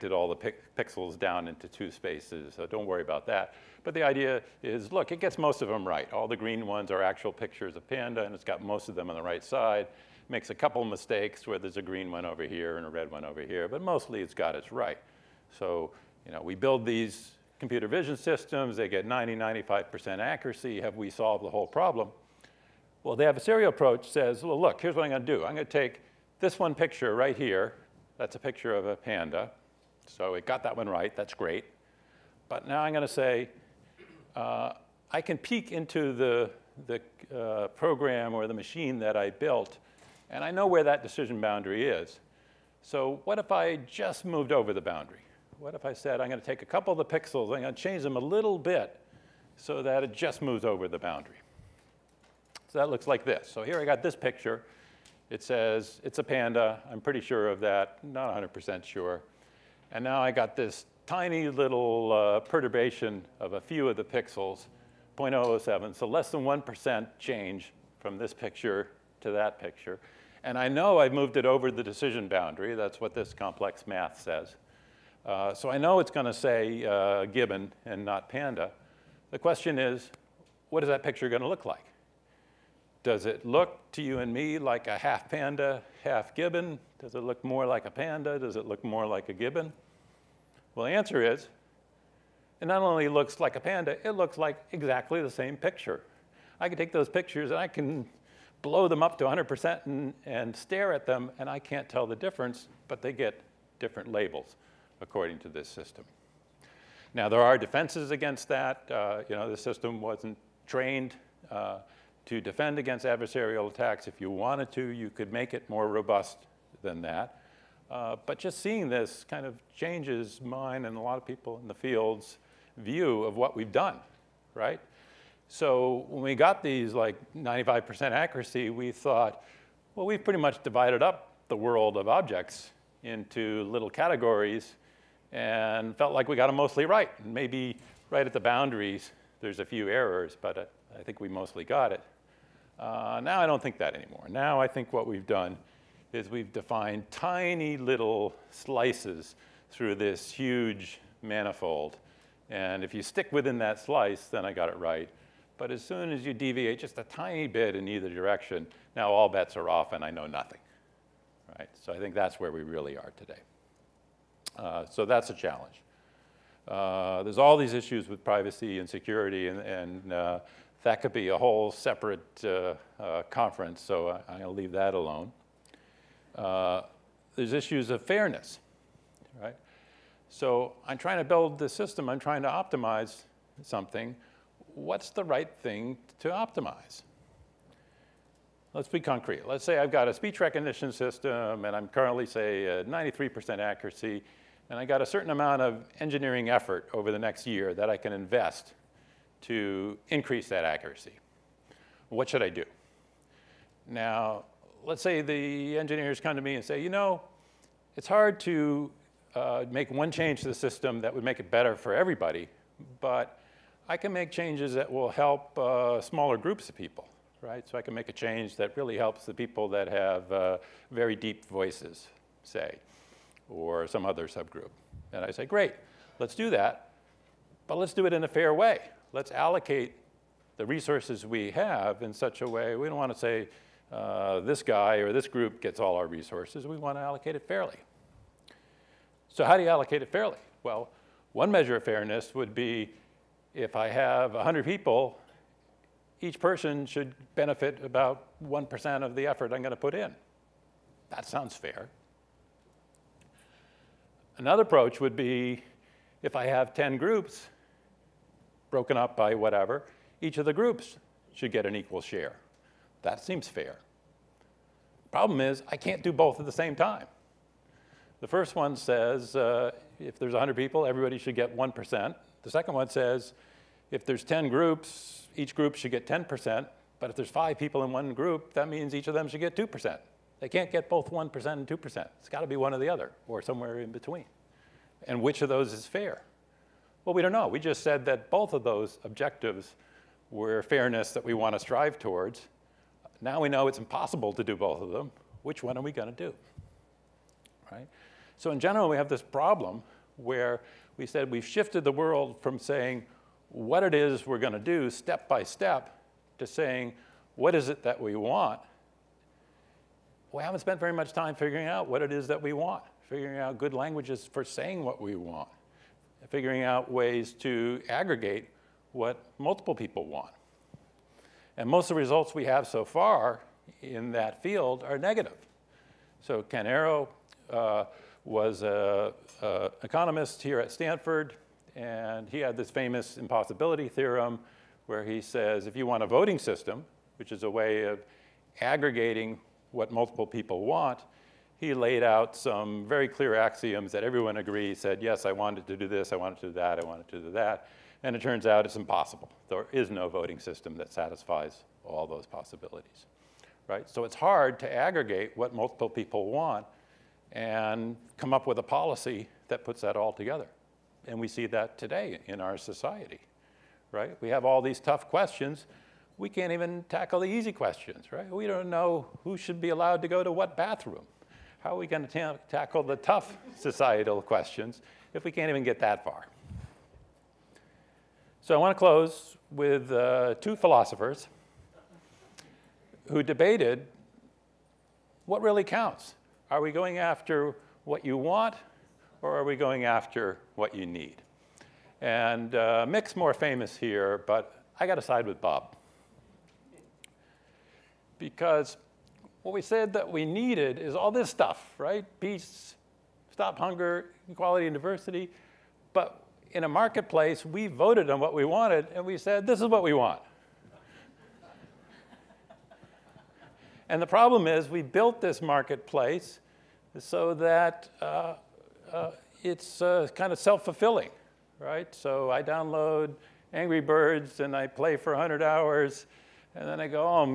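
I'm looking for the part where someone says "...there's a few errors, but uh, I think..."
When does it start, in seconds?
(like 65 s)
139 s.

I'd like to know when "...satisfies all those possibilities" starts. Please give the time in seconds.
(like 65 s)
350 s.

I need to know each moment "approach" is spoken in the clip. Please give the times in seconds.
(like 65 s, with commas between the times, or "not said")
23 s, 254 s.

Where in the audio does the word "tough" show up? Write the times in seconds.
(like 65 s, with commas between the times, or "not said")
364 s, 372 s.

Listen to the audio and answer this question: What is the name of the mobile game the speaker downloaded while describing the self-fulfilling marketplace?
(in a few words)
Angry Birds.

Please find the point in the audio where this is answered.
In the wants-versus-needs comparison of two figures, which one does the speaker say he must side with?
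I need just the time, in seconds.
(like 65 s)
395 s.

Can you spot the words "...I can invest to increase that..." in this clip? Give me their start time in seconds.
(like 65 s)
197 s.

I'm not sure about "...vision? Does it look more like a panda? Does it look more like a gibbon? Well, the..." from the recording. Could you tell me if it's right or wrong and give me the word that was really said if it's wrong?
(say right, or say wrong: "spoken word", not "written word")
wrong: "gibbon", not "vision".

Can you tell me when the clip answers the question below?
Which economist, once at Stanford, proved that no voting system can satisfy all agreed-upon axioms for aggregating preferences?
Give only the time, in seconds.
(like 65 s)
326 s.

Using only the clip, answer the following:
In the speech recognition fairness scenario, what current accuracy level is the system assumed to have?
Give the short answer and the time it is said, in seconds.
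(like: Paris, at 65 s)
93%, at 192 s.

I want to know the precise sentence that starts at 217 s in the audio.
So I can make a change that really helps the people that have uh, very deep voices, say, or some other subgroup.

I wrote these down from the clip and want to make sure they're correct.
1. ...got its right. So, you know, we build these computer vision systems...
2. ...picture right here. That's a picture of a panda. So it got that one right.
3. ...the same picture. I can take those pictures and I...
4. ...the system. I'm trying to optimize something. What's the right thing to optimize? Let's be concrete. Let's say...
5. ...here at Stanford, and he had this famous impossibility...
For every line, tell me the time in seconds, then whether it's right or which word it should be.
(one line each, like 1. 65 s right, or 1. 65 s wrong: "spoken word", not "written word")
1. 14 s right
2. 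26 s right
3. 95 s right
4. 181 s right
5. 330 s right.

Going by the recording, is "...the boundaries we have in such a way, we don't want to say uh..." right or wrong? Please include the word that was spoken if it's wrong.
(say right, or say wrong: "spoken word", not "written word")
wrong: "resources", not "boundaries".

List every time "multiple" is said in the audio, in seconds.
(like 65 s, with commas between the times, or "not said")
319 s, 339 s, 355 s.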